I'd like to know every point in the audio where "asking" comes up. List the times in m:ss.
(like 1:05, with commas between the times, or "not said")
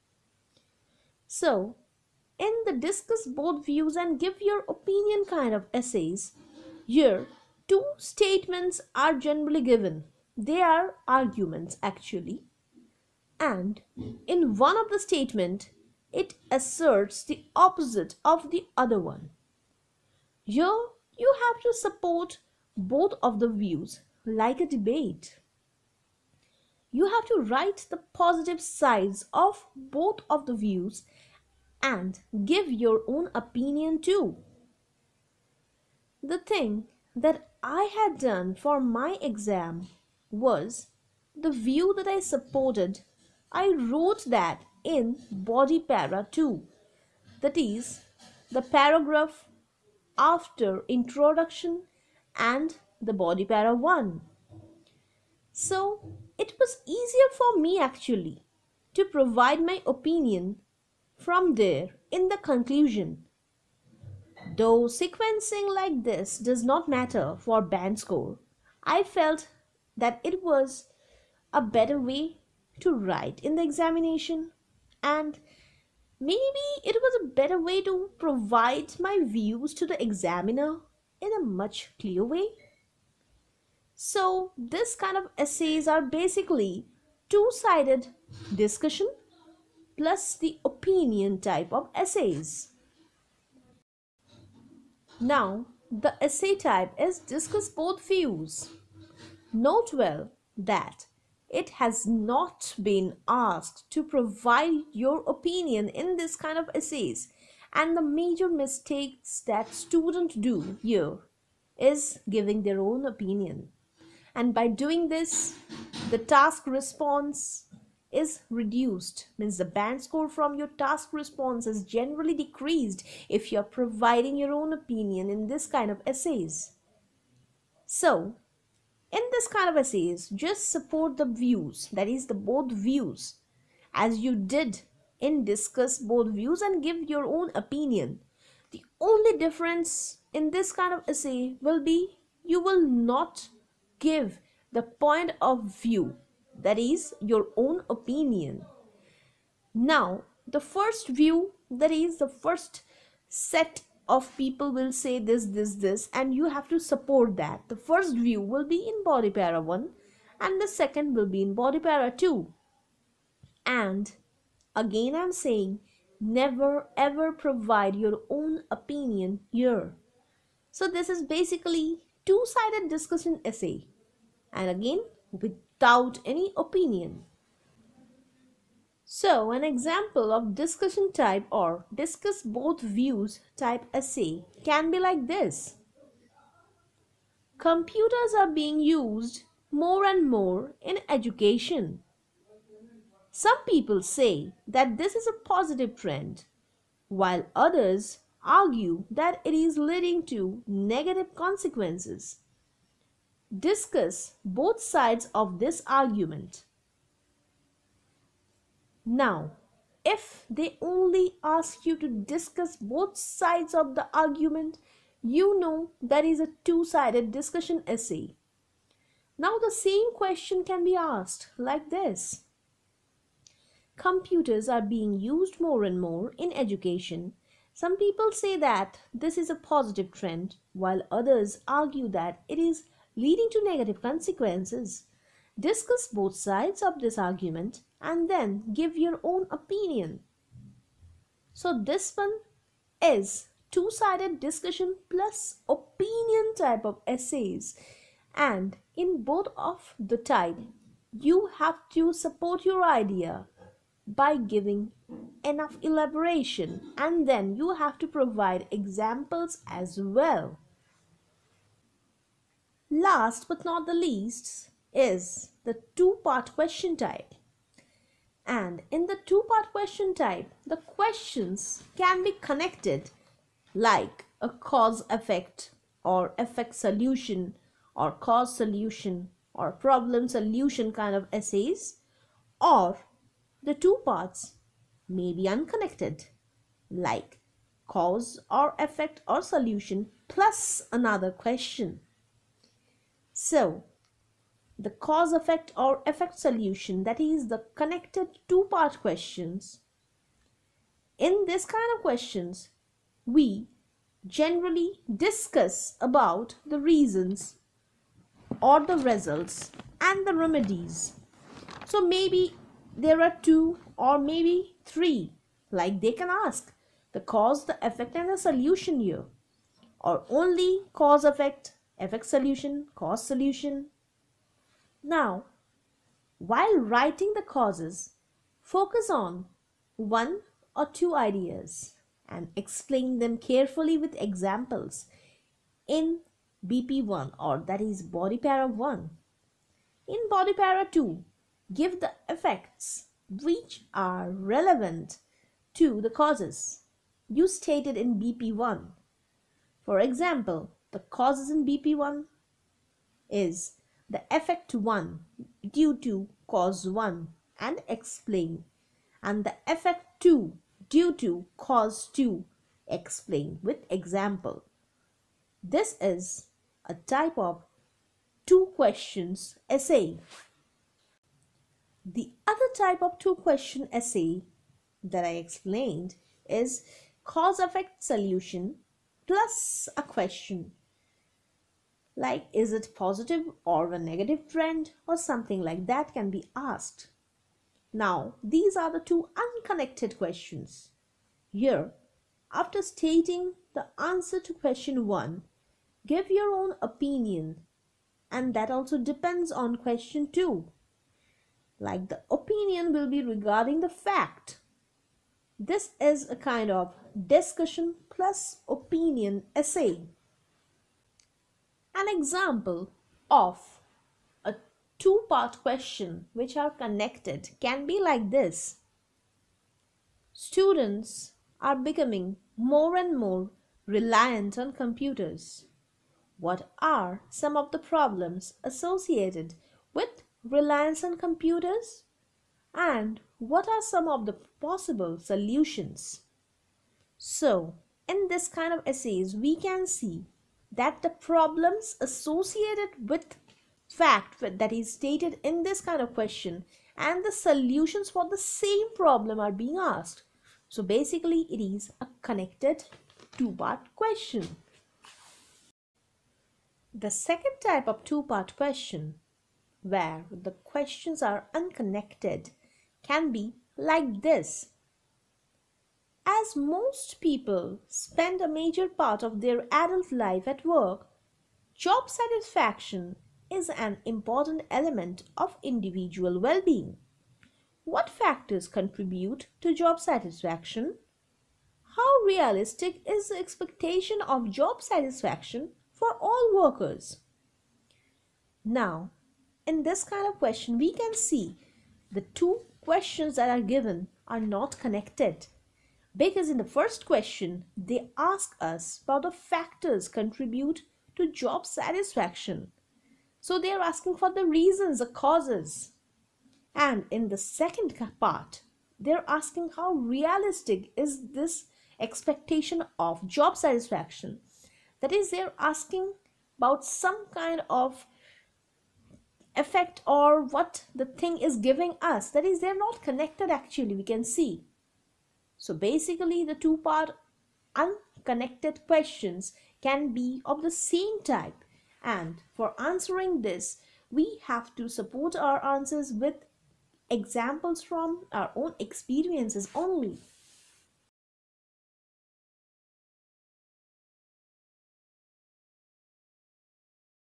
8:23, 8:29, 8:35.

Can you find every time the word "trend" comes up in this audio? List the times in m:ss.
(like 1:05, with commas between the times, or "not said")
3:15, 3:50, 6:24.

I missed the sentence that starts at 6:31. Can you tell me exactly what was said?
Here, after stating the answer to question 1, give your own opinion and that also depends on question 2.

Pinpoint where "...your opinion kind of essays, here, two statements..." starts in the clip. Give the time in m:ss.
0:04.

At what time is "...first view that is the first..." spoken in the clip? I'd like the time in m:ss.
2:30.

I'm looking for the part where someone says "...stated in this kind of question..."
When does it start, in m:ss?
7:24.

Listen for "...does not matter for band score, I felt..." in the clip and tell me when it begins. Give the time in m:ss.
1:06.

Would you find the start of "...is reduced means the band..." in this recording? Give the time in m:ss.
1:58.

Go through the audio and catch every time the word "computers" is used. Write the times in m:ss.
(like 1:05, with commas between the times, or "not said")
3:07, 3:43, 7:04, 7:11.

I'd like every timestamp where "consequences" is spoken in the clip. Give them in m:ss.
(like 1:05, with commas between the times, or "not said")
3:21, 3:54.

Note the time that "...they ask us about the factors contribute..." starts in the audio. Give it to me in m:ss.
8:17.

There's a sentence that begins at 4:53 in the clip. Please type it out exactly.
So, the cause effect or effect solution, that is, the connected two part questions.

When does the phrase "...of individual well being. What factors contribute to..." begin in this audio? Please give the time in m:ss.
7:55.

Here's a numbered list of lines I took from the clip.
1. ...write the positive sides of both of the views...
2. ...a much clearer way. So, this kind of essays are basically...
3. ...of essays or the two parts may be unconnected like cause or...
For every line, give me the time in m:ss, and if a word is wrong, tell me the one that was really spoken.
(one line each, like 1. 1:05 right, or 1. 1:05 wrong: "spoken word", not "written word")
1. 0:27 right
2. 1:21 right
3. 4:41 right.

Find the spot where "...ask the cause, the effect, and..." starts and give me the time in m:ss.
5:16.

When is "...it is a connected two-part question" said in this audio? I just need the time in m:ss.
7:31.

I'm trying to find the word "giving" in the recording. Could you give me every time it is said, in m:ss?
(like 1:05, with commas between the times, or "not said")
1:52, 4:14, 8:41.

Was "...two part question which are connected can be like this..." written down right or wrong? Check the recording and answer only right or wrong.
right.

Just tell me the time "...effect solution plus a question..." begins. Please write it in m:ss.
6:17.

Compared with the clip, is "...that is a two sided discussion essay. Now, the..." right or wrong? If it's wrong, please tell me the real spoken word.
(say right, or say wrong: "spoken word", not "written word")
right.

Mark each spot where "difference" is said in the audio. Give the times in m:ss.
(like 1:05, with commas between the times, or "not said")
2:19.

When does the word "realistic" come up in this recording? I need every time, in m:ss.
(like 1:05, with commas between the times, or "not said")
8:02, 8:29.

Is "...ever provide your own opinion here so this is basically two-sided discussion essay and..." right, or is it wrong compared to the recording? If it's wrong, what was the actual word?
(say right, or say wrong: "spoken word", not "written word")
right.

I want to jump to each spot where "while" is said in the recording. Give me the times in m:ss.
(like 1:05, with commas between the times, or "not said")
3:17, 3:50, 5:26.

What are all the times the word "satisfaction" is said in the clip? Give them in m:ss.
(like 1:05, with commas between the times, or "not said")
7:52, 8:00, 8:04, 8:21, 8:33.